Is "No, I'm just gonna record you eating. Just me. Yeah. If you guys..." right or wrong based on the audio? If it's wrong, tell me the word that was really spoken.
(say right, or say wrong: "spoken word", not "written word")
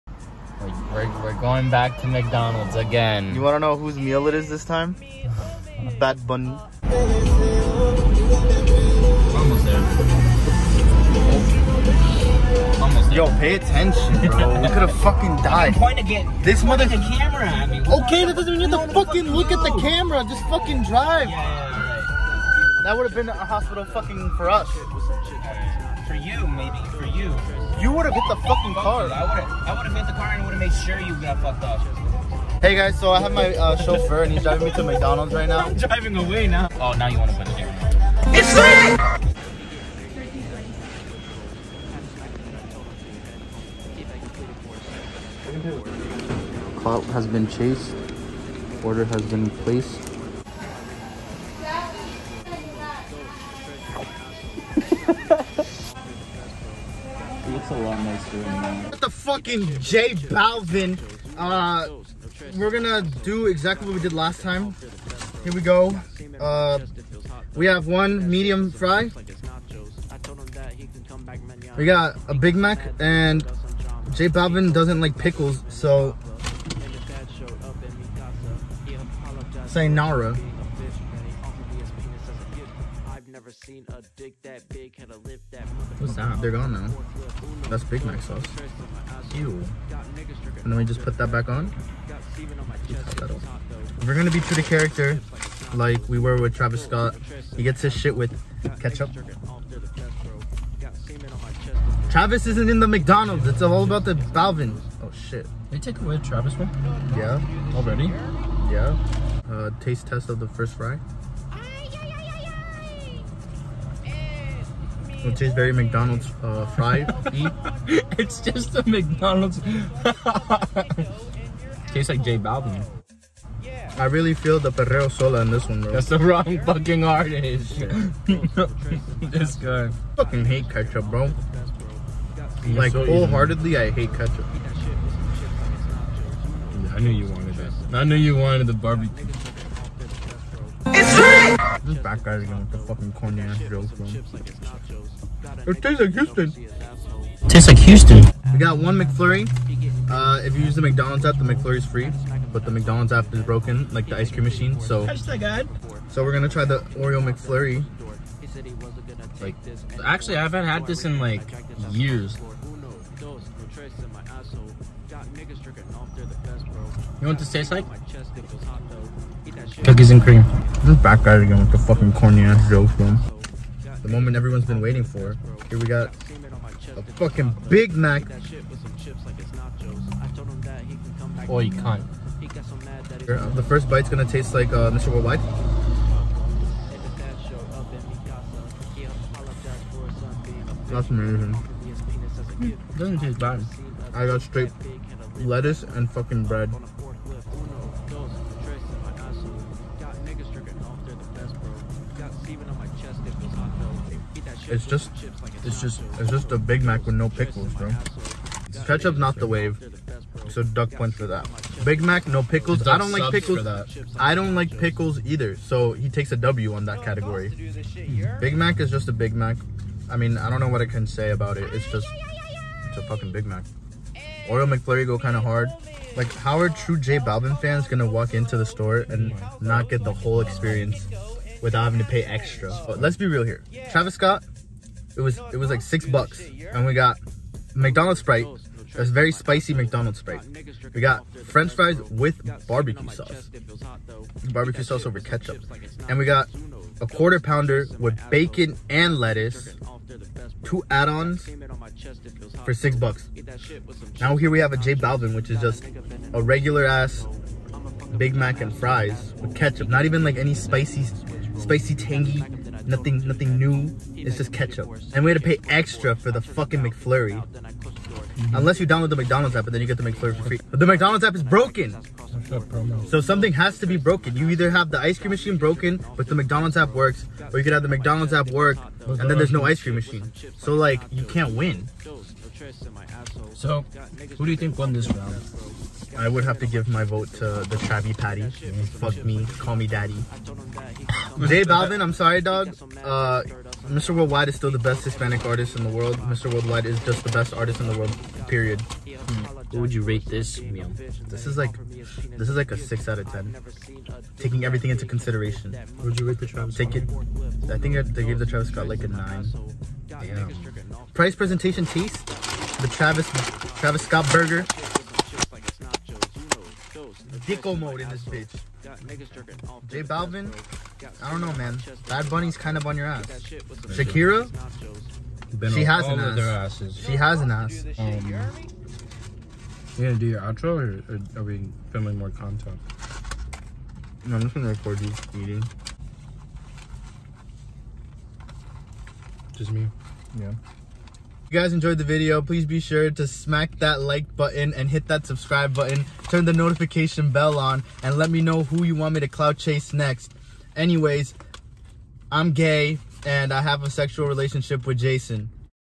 right.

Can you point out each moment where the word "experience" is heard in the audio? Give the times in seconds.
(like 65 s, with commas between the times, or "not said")
230 s.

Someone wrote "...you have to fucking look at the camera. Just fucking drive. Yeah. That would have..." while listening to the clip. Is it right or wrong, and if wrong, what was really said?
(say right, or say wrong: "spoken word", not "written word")
right.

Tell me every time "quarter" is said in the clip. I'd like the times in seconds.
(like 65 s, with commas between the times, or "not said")
247 s.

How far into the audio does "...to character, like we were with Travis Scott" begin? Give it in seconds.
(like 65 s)
94 s.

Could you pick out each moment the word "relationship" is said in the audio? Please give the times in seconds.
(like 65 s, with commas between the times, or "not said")
354 s.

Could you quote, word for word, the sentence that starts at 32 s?
Hey guys, so I have my uh, chauffeur and he's driving me to McDonald's right now.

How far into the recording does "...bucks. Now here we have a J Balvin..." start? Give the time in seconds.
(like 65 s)
252 s.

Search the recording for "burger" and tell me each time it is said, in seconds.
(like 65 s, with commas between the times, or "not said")
314 s.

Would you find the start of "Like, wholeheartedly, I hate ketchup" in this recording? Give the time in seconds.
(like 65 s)
132 s.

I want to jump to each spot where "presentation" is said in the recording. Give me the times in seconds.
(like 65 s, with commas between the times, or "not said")
311 s.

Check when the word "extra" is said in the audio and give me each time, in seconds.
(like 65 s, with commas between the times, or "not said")
232 s, 265 s.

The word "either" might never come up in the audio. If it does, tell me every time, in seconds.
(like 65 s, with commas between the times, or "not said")
215 s, 274 s.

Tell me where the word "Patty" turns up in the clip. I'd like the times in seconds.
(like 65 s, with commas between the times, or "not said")
288 s.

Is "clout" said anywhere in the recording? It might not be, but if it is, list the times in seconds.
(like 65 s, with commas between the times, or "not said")
46 s, 349 s.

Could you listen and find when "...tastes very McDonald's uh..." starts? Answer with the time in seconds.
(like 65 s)
115 s.